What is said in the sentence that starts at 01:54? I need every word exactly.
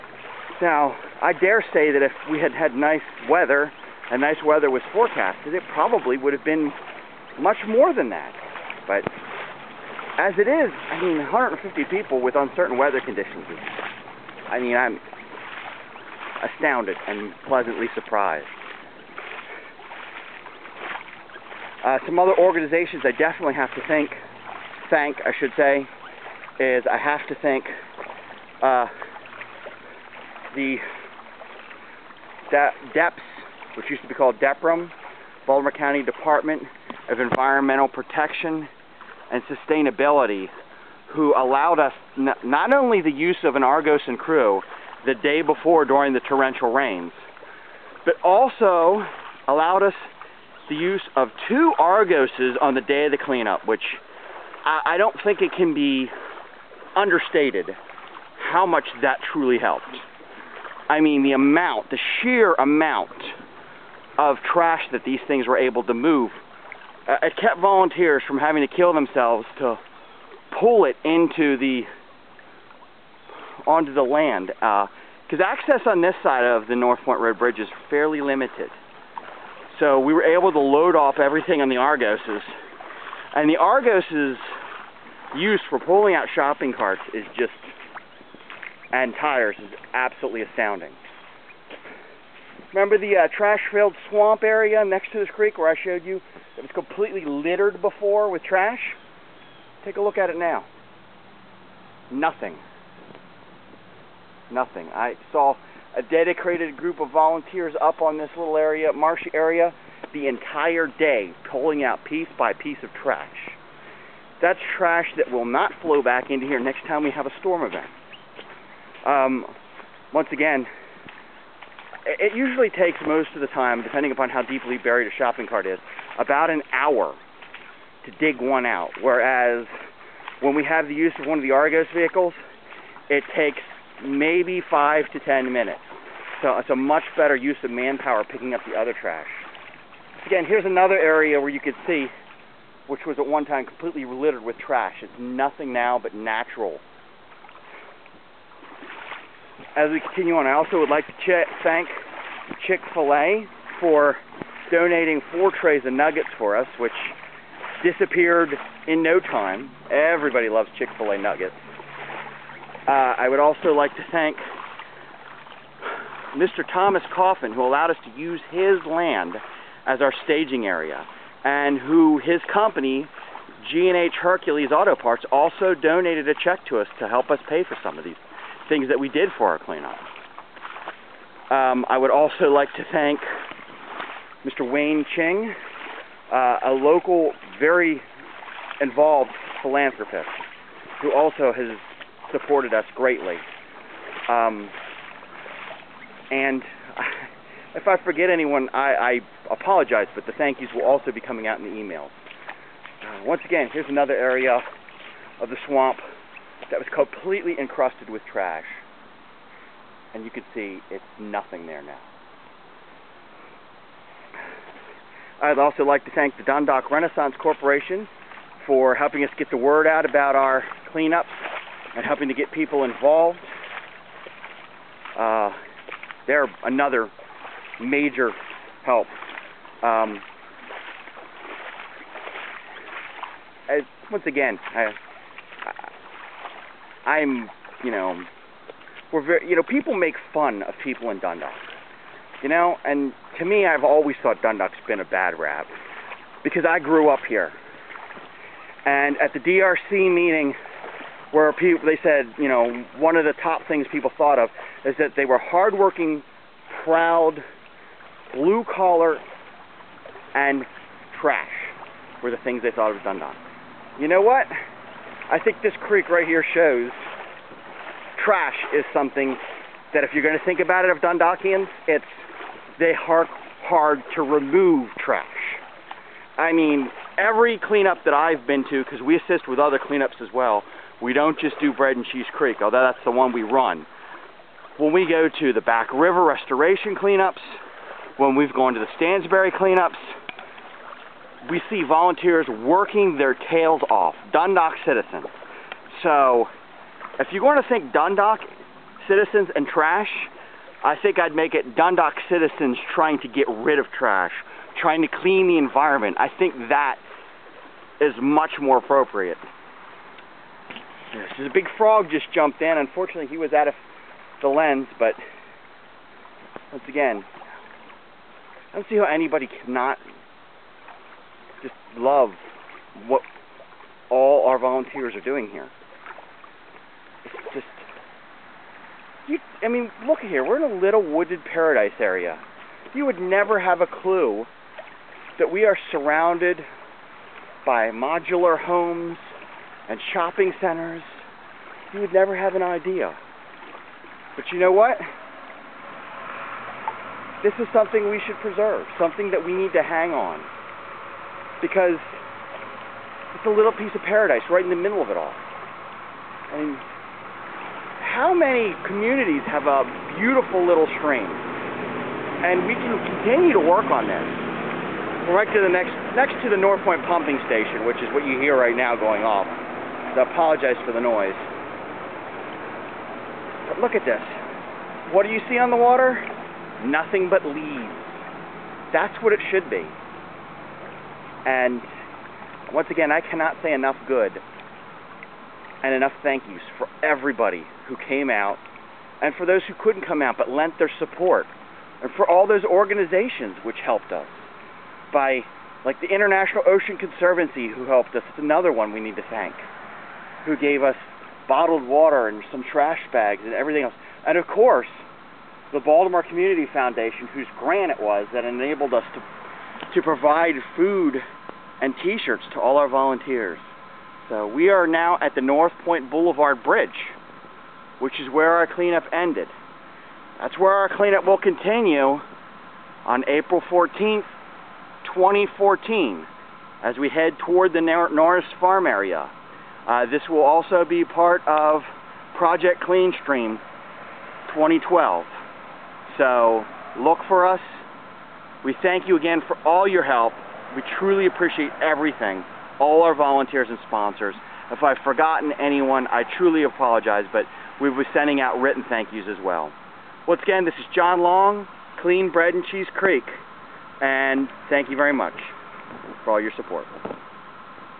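That's trash that will not flow back into here next time we have a storm event.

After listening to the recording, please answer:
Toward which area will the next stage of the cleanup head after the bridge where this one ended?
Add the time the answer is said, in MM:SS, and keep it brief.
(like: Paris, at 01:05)
Norris Farm, at 07:07.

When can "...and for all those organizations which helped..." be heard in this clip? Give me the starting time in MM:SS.
06:32.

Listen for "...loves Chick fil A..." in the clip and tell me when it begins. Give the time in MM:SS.
02:40.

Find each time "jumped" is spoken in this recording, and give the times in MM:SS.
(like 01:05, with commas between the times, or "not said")
05:12.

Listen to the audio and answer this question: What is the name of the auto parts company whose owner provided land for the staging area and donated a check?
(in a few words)
G&H Hercules Auto Parts.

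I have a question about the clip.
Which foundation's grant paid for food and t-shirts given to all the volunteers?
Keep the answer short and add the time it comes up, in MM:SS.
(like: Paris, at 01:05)
Baltimore Community Foundation, at 06:45.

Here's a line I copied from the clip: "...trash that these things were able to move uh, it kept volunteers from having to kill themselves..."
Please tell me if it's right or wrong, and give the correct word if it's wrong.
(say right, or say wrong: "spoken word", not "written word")
right.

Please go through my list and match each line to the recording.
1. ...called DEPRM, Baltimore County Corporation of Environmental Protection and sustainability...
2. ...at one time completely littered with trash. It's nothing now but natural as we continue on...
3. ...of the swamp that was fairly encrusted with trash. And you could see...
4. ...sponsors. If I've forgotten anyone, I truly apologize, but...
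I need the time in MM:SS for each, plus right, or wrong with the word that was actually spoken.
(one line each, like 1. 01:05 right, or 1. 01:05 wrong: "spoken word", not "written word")
1. 00:34 wrong: "Department", not "Corporation"
2. 02:23 right
3. 03:25 wrong: "completely", not "fairly"
4. 07:23 right.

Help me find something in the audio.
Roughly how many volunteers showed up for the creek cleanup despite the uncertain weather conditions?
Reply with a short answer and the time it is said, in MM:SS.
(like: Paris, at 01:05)
150, at 00:11.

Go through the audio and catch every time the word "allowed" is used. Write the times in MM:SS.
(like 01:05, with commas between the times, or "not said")
00:41, 00:49, 02:47.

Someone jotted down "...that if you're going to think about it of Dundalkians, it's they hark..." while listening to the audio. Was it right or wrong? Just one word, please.
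right.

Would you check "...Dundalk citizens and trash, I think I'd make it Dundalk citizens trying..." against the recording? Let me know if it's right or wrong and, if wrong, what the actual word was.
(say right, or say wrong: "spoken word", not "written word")
right.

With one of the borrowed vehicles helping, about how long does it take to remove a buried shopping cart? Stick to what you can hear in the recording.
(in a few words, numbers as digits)
5 to 10 minutes.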